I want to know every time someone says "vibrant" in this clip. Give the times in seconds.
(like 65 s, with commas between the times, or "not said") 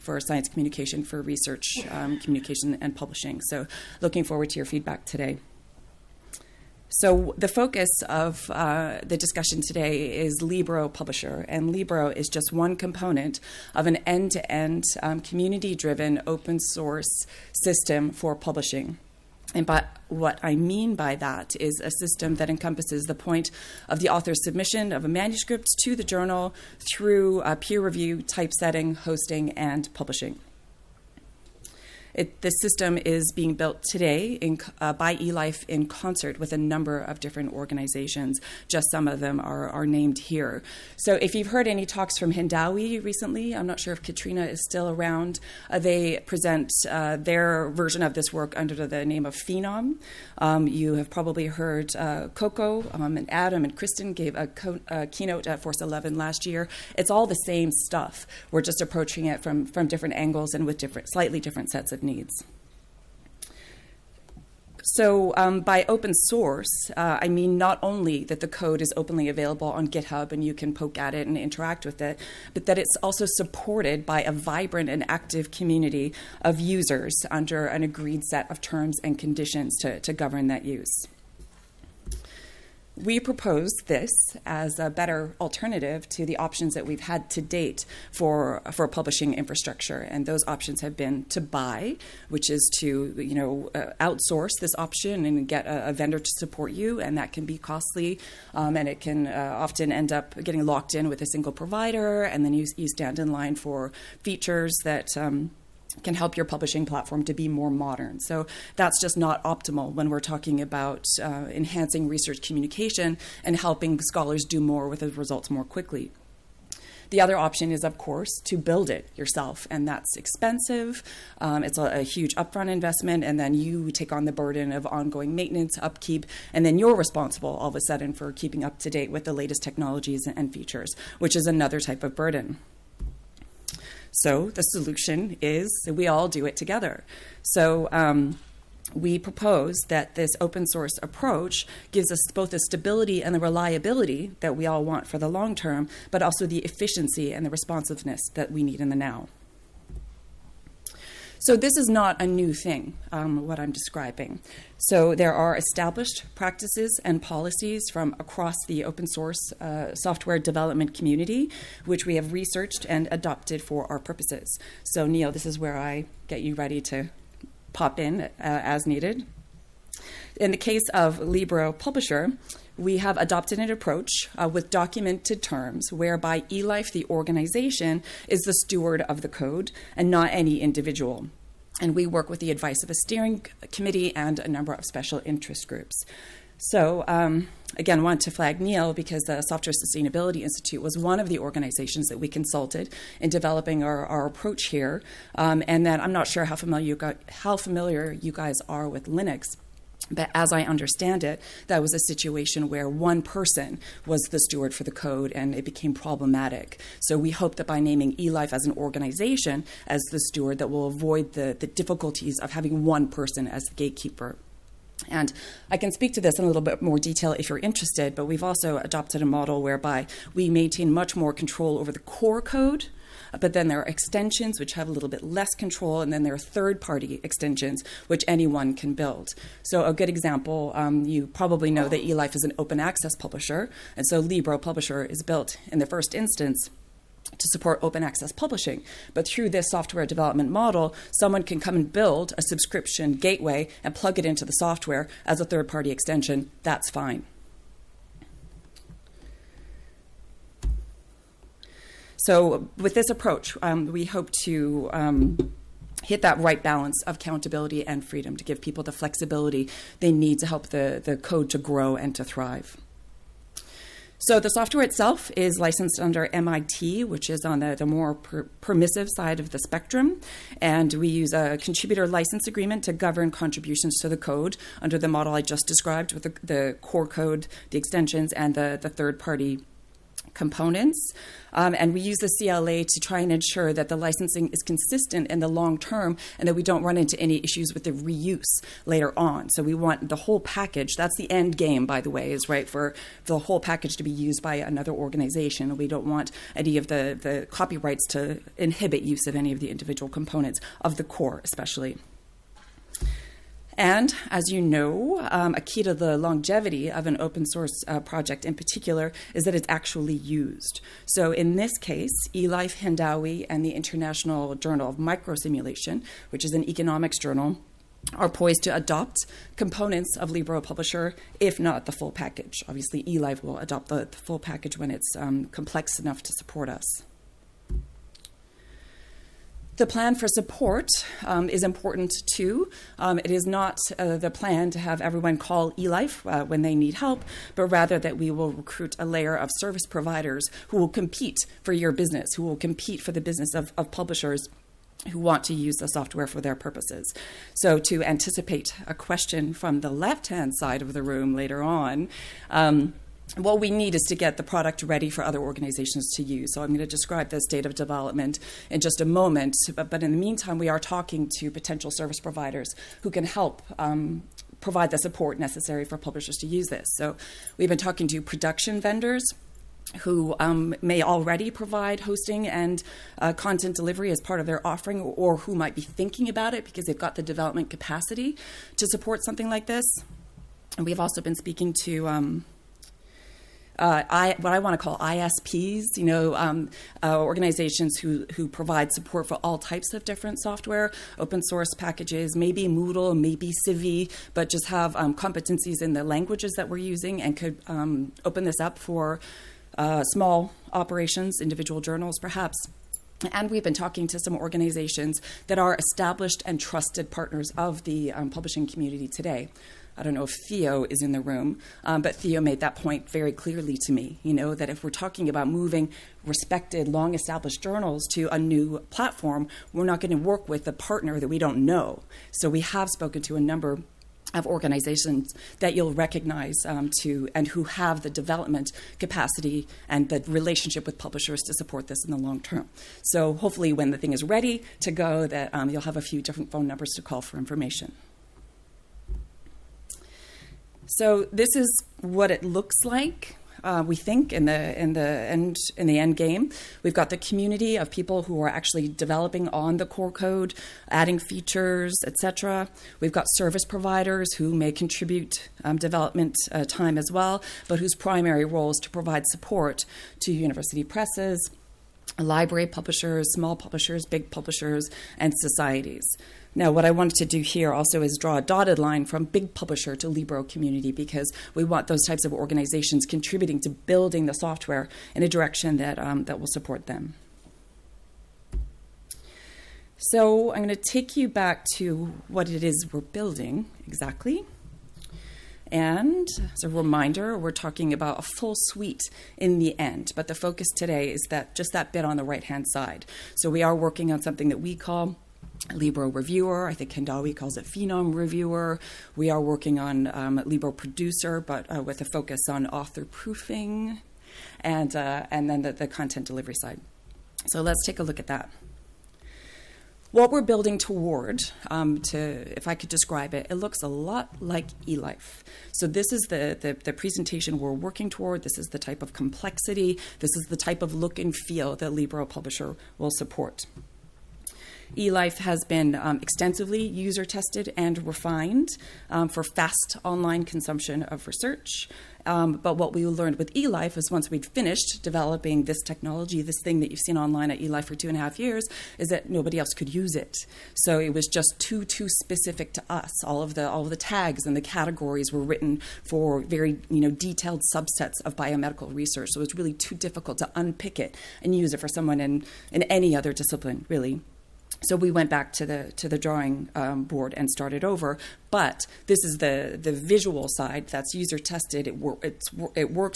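74 s.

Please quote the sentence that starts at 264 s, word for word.
So the software itself is licensed under MIT, which is on the, the more per permissive side of the spectrum.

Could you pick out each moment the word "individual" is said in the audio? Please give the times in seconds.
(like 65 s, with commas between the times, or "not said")
180 s, 299 s, 401 s.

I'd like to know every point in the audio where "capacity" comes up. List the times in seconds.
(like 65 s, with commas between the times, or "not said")
377 s, 428 s.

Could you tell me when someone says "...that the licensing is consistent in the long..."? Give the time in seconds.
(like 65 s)
283 s.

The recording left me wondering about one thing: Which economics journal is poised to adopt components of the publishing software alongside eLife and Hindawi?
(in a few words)
International Journal of Microsimulation.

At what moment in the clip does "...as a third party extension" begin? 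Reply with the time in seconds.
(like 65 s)
245 s.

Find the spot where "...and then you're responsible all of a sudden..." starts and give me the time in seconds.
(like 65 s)
126 s.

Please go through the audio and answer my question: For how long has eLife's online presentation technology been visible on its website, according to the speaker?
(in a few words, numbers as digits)
two and a half years.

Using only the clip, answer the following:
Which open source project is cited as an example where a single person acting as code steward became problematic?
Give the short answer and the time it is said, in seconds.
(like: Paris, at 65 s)
Linux, at 199 s.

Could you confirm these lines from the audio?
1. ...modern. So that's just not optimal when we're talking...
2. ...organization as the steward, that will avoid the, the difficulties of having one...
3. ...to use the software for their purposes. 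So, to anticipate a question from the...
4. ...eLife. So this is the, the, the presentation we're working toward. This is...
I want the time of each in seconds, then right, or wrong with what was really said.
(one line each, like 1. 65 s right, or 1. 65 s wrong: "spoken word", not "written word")
1. 107 s right
2. 208 s right
3. 345 s right
4. 514 s right.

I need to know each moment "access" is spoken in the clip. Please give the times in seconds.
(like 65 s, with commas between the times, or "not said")
232 s, 238 s.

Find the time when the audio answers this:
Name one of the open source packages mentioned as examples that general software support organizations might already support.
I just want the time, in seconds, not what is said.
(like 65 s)
392 s.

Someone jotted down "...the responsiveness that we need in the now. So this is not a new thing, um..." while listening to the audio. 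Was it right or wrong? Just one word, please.
right.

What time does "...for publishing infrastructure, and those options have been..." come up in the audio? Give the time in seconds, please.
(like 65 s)
88 s.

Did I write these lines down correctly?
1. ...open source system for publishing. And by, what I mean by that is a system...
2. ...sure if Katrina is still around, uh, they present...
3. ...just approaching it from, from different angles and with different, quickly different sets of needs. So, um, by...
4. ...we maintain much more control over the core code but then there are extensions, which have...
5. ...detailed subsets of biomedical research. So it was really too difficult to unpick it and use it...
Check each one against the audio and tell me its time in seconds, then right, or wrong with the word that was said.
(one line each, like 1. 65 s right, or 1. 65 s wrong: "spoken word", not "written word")
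1. 16 s right
2. 43 s right
3. 58 s wrong: "slightly", not "quickly"
4. 220 s right
5. 547 s right.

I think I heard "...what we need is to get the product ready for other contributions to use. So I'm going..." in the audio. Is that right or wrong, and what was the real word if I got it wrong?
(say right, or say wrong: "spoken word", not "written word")
wrong: "organizations", not "contributions".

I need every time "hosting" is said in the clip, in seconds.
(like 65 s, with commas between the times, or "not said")
28 s, 372 s.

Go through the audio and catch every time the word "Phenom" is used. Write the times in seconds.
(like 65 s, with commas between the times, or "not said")
49 s, 497 s.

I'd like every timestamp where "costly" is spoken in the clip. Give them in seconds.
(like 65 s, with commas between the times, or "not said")
97 s.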